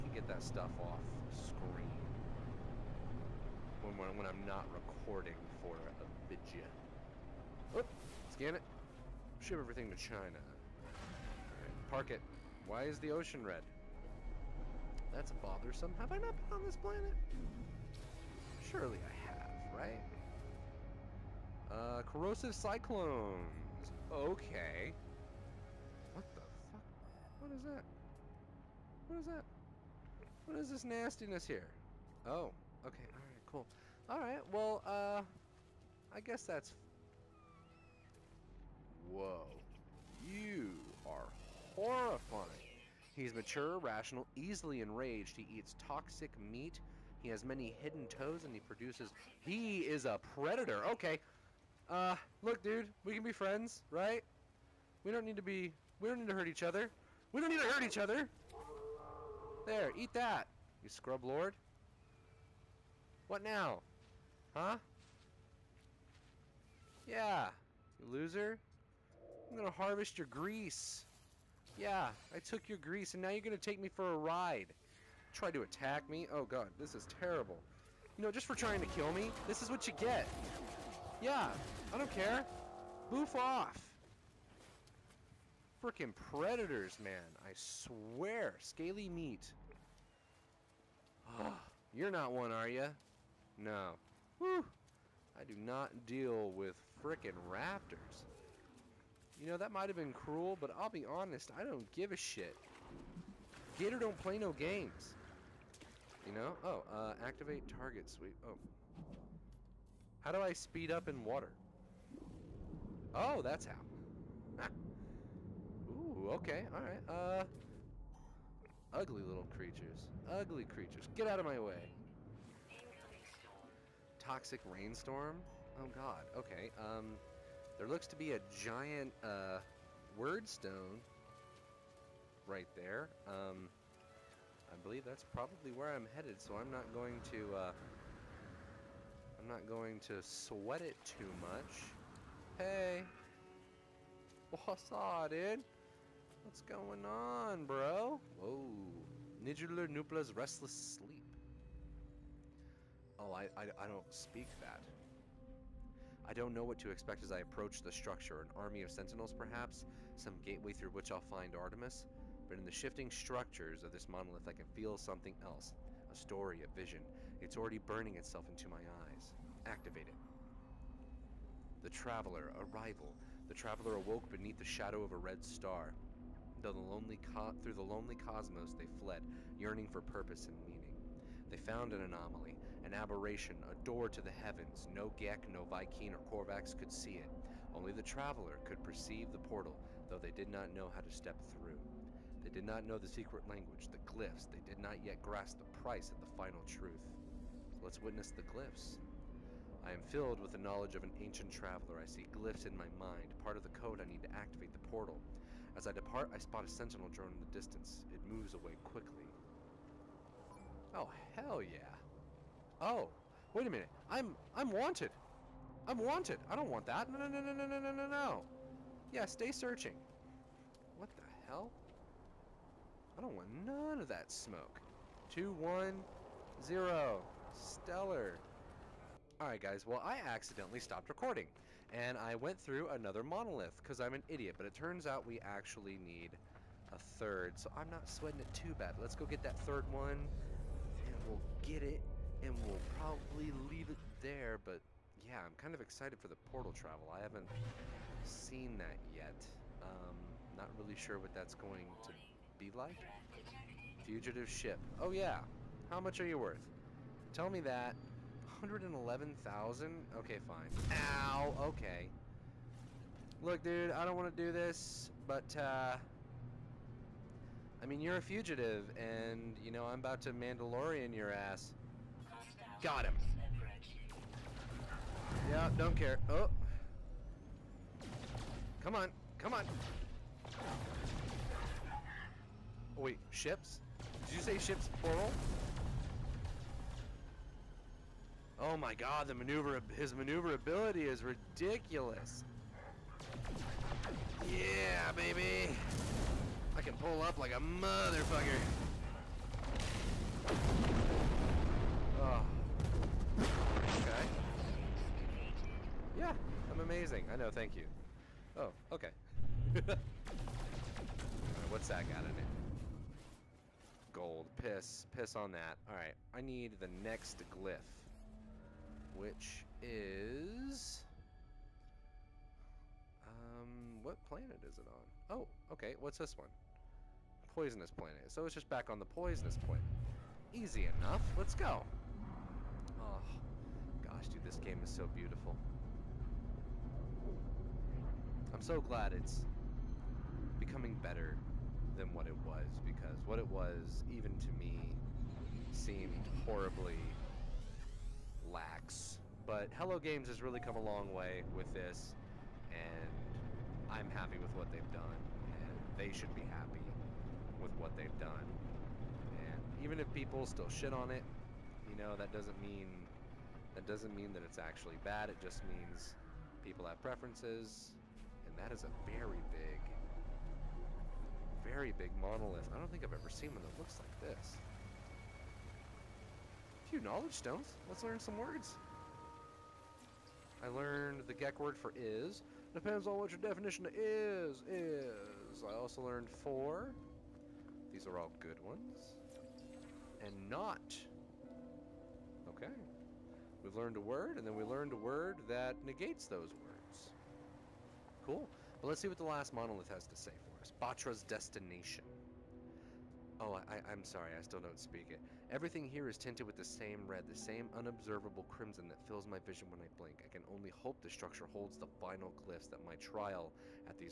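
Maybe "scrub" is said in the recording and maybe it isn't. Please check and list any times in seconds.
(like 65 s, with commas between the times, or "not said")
60 s.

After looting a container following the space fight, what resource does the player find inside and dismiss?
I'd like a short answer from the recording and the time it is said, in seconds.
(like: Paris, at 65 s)
Gold, at 314 s.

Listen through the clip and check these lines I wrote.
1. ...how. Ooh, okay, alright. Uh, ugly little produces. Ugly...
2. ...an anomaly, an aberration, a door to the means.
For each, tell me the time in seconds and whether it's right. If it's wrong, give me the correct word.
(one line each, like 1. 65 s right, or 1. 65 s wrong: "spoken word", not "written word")
1. 113 s wrong: "creatures", not "produces"
2. 181 s wrong: "heavens", not "means".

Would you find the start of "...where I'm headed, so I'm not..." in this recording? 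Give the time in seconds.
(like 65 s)
135 s.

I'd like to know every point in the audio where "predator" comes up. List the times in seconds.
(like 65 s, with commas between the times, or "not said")
50 s, 86 s.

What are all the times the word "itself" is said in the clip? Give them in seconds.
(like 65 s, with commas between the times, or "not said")
168 s.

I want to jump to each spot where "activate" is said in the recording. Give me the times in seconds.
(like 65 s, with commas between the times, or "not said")
107 s, 169 s, 204 s.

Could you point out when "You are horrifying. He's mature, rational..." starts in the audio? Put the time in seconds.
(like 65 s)
40 s.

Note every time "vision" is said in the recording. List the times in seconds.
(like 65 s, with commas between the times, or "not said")
166 s, 409 s.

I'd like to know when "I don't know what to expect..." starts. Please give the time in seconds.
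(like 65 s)
156 s.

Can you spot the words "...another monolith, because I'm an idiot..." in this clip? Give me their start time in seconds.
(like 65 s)
232 s.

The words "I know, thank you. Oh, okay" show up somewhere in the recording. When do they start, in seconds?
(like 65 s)
307 s.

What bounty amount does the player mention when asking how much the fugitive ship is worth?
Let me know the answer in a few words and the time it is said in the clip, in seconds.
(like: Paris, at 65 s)
111,000, at 258 s.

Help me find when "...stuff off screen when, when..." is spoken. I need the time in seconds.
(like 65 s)
0 s.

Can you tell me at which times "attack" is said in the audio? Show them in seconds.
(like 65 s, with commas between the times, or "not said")
75 s.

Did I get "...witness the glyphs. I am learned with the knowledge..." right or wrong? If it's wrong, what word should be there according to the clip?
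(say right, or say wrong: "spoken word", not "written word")
wrong: "filled", not "learned".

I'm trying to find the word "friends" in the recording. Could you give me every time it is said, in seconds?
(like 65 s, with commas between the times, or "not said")
53 s.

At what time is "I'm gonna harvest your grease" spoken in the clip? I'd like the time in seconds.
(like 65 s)
69 s.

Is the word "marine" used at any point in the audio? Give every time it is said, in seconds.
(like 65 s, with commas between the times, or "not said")
not said.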